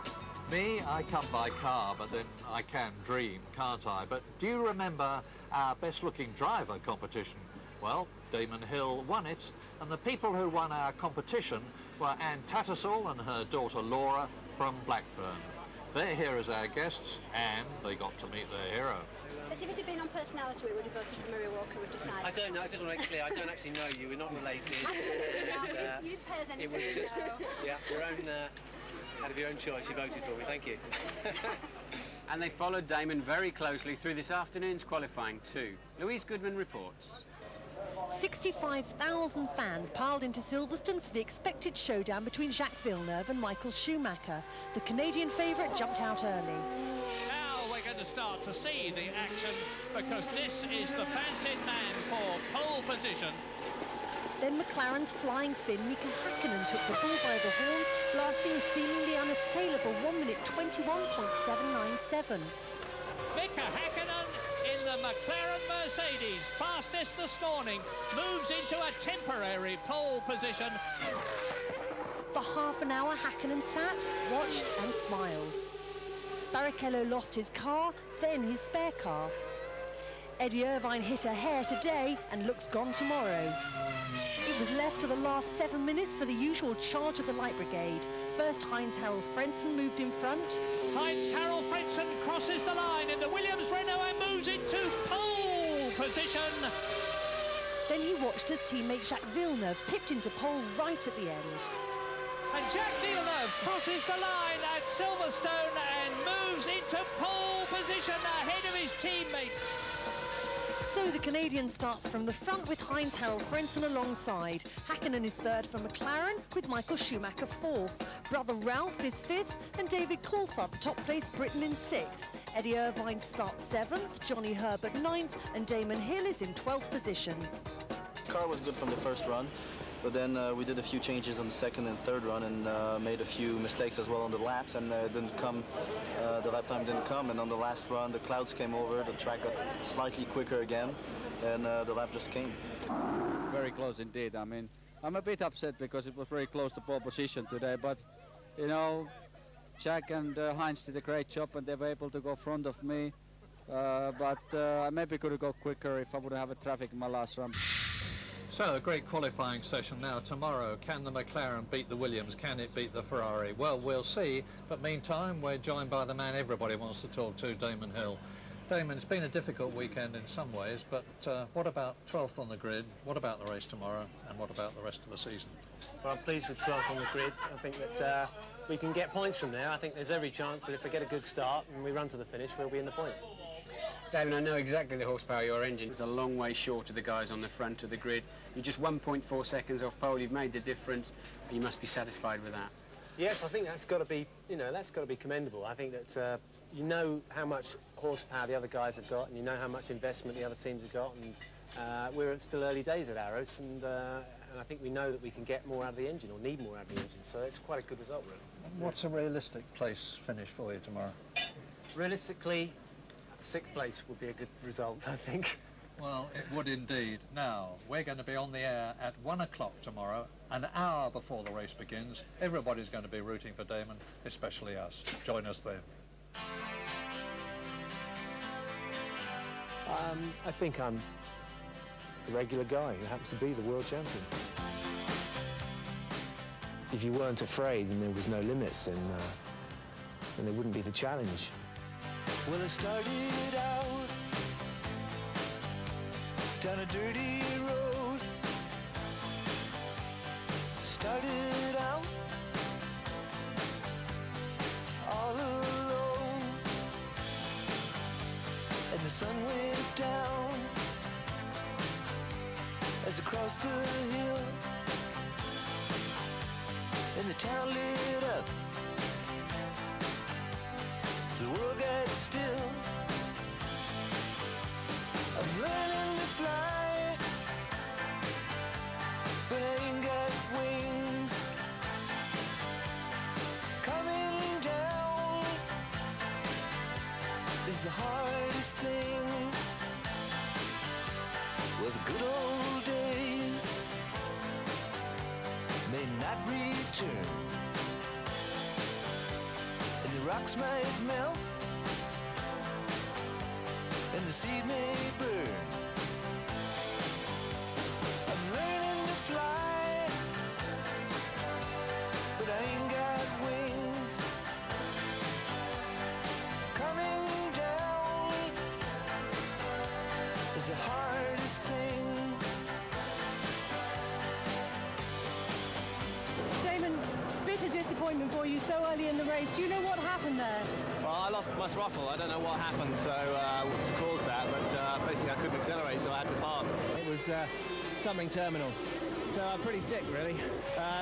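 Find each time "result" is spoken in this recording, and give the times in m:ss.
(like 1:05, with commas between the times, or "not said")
3:27, 3:34.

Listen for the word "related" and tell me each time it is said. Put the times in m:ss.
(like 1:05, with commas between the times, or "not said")
0:24.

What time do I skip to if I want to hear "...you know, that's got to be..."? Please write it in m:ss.
3:14.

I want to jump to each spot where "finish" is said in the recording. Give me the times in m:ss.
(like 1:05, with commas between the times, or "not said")
3:02, 3:30.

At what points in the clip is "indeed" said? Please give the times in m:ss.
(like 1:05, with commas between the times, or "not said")
2:23, 3:36.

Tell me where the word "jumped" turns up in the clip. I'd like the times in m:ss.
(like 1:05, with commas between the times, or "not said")
0:45.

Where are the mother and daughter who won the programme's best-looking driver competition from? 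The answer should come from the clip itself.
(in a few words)
Blackburn.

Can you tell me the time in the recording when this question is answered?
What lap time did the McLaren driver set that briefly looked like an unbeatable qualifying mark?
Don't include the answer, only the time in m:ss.
1:00.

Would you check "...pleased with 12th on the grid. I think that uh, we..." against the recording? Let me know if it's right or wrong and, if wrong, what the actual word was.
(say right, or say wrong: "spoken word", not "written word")
right.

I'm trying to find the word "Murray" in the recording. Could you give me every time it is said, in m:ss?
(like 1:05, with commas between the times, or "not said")
0:21.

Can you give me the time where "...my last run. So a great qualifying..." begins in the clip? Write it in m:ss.
2:36.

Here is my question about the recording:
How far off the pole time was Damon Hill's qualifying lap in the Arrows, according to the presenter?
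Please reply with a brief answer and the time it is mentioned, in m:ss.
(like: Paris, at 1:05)
1.4 seconds, at 3:08.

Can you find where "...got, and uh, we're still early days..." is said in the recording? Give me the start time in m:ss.
3:20.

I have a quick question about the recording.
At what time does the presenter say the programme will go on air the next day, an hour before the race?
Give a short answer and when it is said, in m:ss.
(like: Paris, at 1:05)
1 o'clock, at 3:39.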